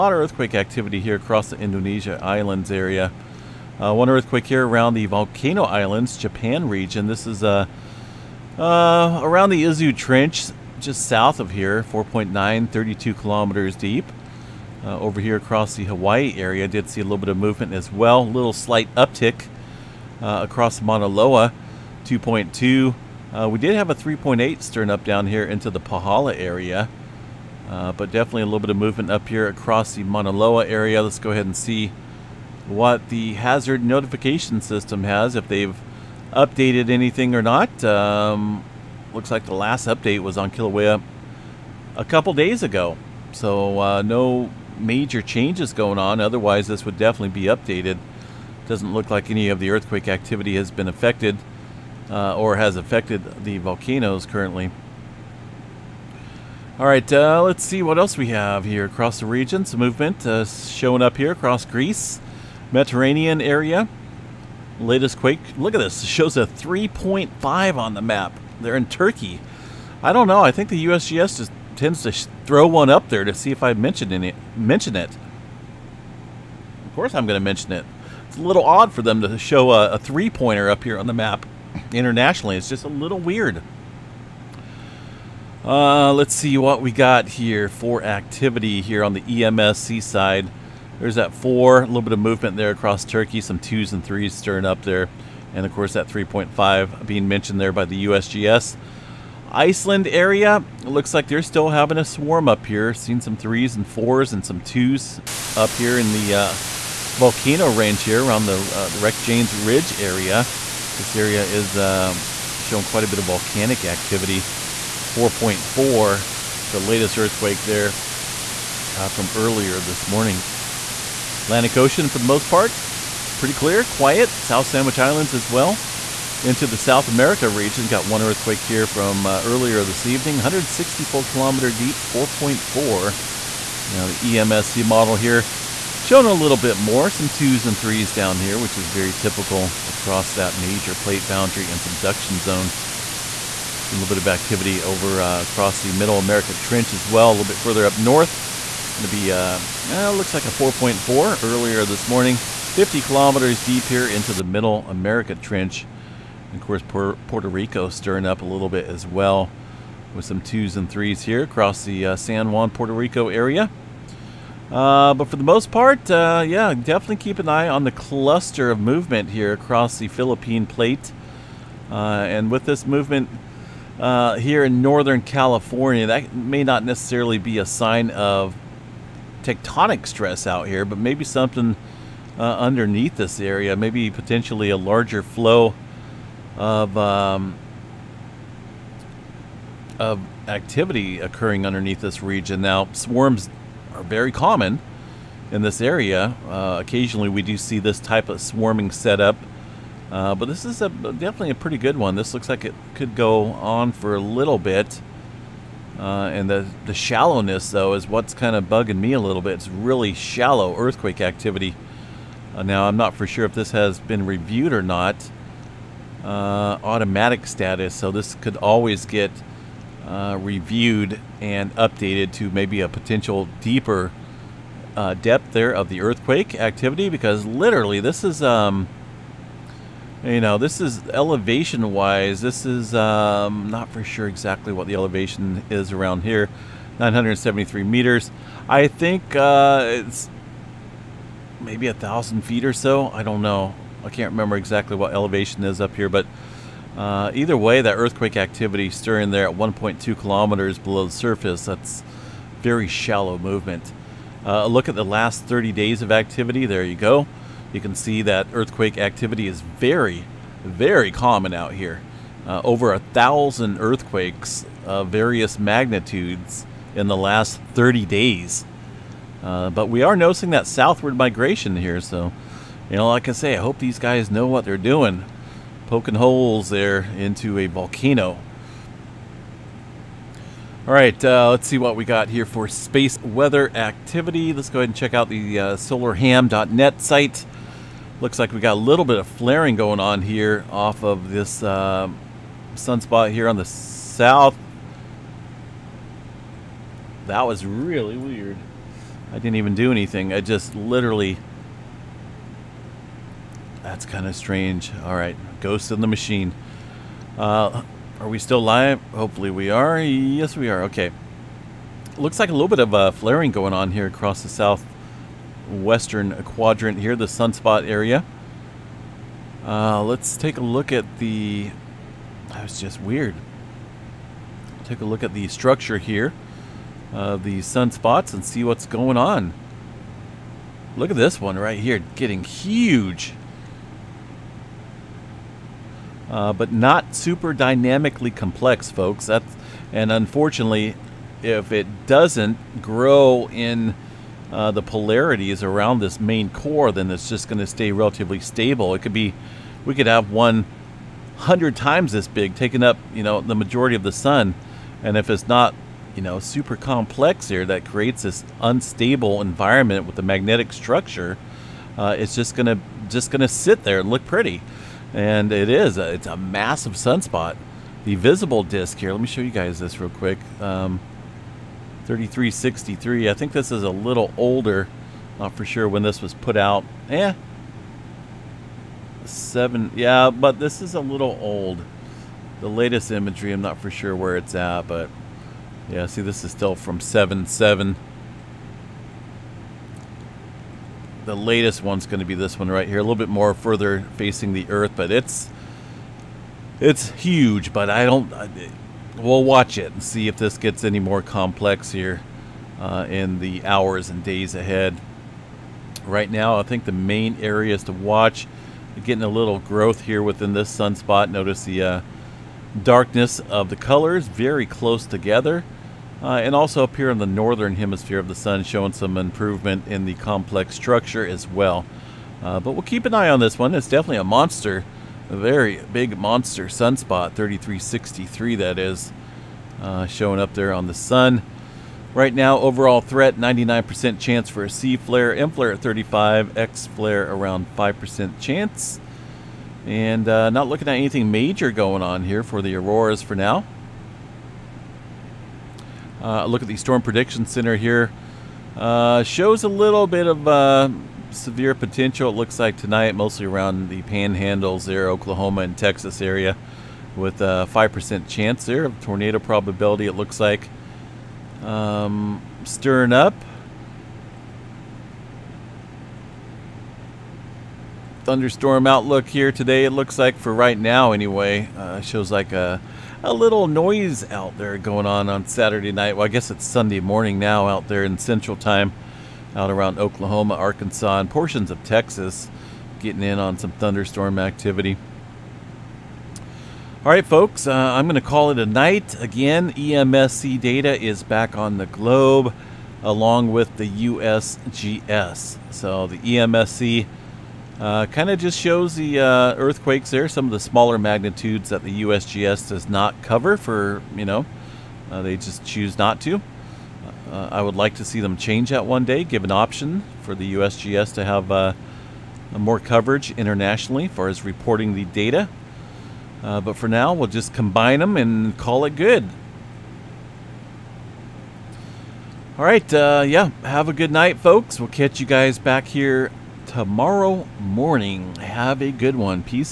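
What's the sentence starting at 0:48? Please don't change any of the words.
Doesn't look like any of the earthquake activity has been affected uh, or has affected the volcanoes currently.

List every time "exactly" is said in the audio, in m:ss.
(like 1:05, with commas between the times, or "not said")
3:54, 4:04.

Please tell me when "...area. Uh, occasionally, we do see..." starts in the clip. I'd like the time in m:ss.
3:15.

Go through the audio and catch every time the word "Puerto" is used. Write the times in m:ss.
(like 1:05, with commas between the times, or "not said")
2:37, 2:42.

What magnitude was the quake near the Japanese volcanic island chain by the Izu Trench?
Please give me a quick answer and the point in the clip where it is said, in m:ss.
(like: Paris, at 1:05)
4.9, at 0:11.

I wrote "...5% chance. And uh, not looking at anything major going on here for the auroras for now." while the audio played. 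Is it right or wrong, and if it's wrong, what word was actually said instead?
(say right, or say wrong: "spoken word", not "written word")
right.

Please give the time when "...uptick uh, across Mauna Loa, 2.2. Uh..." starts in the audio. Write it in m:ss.
0:18.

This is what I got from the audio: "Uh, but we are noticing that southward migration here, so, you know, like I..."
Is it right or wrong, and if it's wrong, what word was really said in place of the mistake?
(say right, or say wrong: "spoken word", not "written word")
right.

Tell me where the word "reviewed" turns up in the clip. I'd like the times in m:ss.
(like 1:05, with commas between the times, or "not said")
3:34, 3:40.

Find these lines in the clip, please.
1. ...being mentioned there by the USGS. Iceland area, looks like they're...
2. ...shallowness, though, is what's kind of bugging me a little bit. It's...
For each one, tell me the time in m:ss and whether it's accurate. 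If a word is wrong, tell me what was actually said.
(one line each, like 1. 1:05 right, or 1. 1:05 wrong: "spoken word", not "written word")
1. 1:37 right
2. 3:26 right.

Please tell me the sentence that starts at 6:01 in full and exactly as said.
Uh, it's just gonna just gonna sit there and look pretty, and it is.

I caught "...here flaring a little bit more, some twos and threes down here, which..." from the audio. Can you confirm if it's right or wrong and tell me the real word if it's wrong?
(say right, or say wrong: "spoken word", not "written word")
wrong: "showing", not "flaring".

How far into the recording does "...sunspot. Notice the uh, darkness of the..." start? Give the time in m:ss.
6:50.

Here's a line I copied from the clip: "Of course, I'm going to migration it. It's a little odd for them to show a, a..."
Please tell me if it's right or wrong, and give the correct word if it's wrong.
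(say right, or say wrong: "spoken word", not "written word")
wrong: "mention", not "migration".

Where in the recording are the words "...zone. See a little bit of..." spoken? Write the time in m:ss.
2:22.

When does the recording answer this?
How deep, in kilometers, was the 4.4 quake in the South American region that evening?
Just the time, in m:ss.
2:10.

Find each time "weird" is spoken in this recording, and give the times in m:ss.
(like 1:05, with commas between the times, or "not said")
1:23, 4:58, 5:23.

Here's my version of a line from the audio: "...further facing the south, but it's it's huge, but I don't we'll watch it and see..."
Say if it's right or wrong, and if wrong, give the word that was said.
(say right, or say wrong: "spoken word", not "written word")
wrong: "earth", not "south".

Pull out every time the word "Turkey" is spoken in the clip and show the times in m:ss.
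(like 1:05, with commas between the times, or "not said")
1:08, 1:33.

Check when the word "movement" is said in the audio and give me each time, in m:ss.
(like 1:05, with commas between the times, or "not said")
0:17, 0:28, 0:59, 1:32, 2:48, 2:52, 4:13.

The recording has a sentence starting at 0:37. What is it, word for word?
Um, looks like the last update was on Kilauea a couple days ago.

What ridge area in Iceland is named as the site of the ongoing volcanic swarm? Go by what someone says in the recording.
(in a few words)
Reykjanes Ridge.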